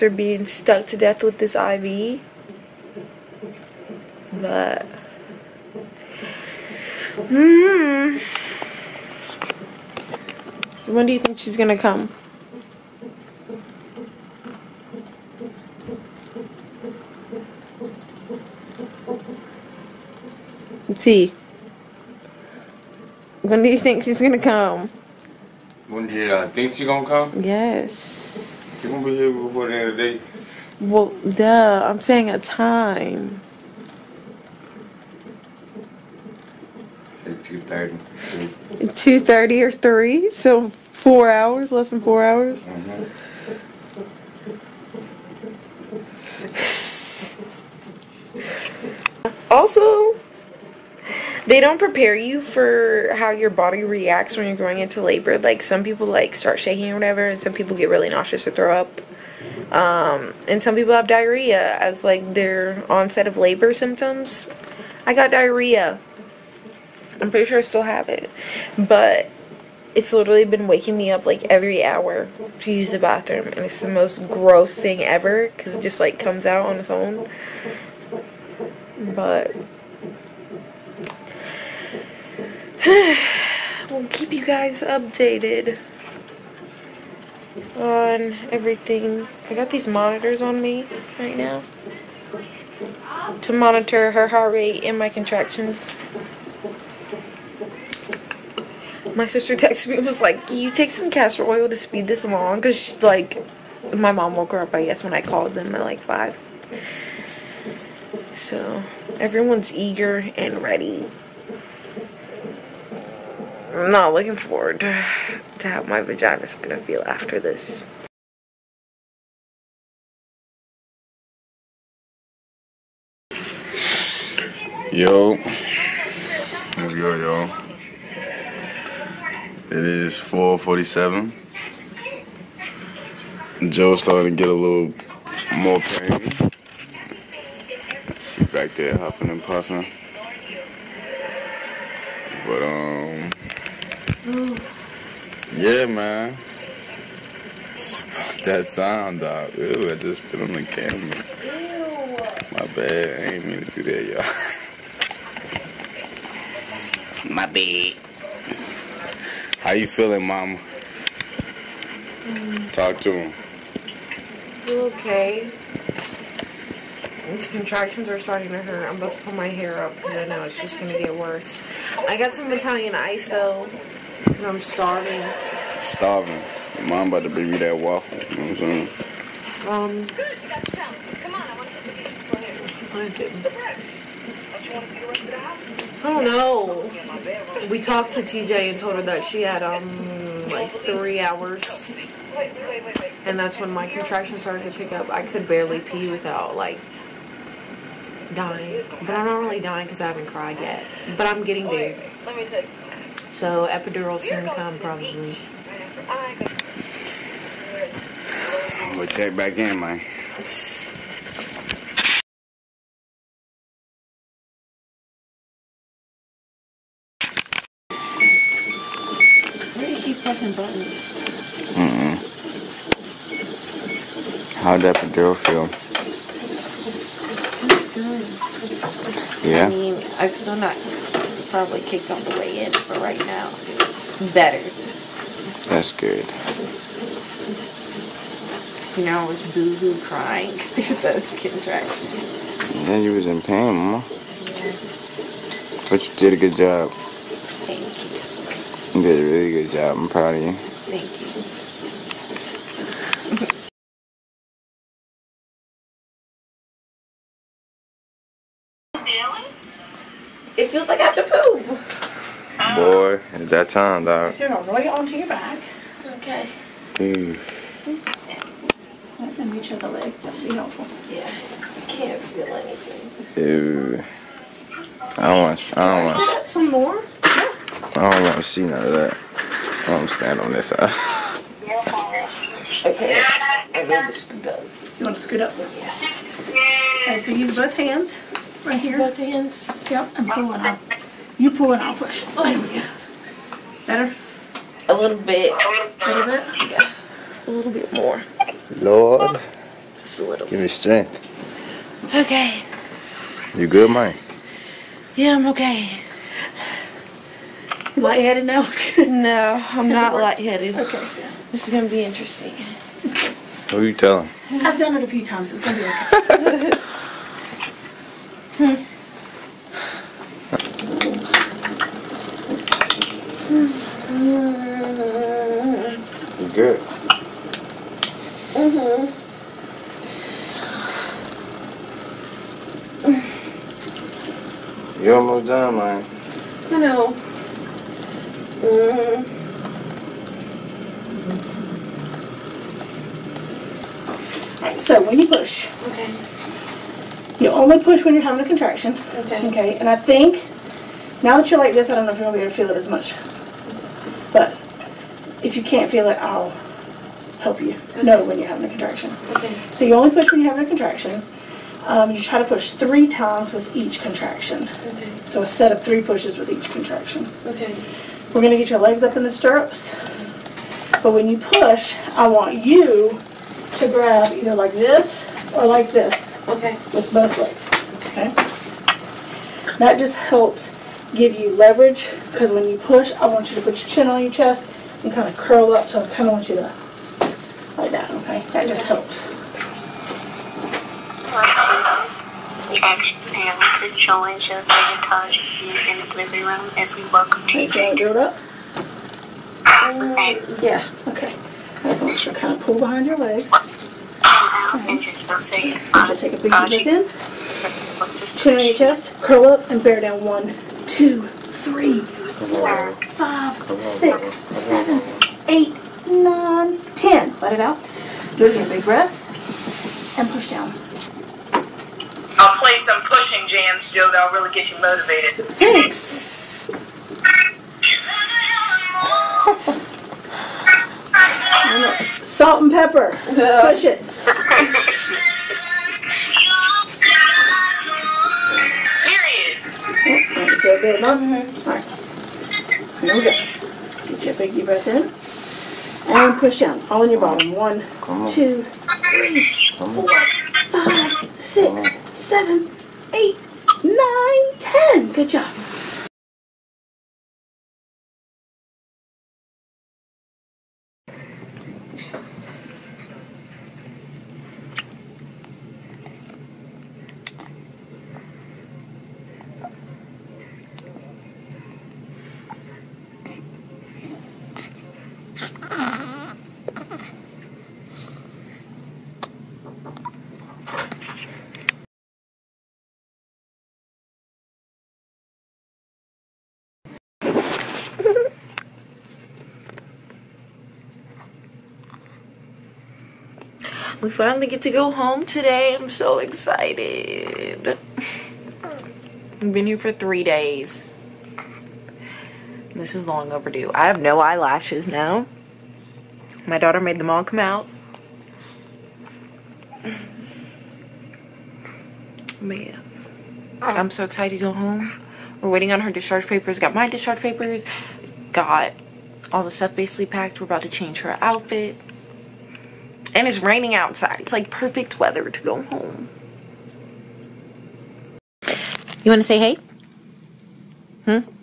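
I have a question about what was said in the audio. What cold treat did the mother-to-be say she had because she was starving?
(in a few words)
Italian ice.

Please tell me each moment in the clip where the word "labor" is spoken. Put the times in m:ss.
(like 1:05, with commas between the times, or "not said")
0:55, 1:03.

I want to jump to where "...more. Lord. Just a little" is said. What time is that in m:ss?
4:57.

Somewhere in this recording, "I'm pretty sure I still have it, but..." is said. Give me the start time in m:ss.
1:07.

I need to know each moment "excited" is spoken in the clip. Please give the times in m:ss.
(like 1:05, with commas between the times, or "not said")
8:16, 8:34.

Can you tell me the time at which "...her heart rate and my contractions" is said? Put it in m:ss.
1:34.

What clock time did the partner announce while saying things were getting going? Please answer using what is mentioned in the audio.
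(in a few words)
4:47.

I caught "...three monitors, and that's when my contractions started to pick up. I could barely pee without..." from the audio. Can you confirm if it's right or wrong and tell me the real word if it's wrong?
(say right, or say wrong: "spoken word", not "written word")
wrong: "hours", not "monitors".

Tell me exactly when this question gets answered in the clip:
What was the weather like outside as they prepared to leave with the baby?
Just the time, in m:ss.
8:43.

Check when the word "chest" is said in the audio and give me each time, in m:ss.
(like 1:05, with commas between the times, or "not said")
6:24, 6:48.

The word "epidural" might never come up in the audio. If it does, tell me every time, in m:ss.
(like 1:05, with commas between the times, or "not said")
3:23, 3:45.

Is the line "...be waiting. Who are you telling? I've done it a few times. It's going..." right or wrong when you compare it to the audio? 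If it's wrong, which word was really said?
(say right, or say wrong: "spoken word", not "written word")
wrong: "interesting", not "waiting".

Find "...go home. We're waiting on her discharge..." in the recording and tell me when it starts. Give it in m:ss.
8:34.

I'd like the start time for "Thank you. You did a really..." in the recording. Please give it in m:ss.
4:06.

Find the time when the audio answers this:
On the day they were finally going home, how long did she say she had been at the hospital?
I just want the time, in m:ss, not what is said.
8:19.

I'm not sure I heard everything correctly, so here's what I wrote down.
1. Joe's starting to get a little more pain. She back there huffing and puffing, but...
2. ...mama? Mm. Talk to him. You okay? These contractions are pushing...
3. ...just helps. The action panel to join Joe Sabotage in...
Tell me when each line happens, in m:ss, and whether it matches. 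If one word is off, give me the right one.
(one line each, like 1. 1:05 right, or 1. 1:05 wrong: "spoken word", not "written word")
1. 2:13 right
2. 2:40 wrong: "starting", not "pushing"
3. 6:28 right.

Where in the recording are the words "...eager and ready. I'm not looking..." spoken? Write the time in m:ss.
1:49.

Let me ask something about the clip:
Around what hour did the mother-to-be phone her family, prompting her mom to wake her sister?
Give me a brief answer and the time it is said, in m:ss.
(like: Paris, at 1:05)
5, at 1:46.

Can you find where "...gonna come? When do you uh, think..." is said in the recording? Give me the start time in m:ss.
0:24.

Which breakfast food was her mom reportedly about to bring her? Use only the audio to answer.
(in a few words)
Waffle.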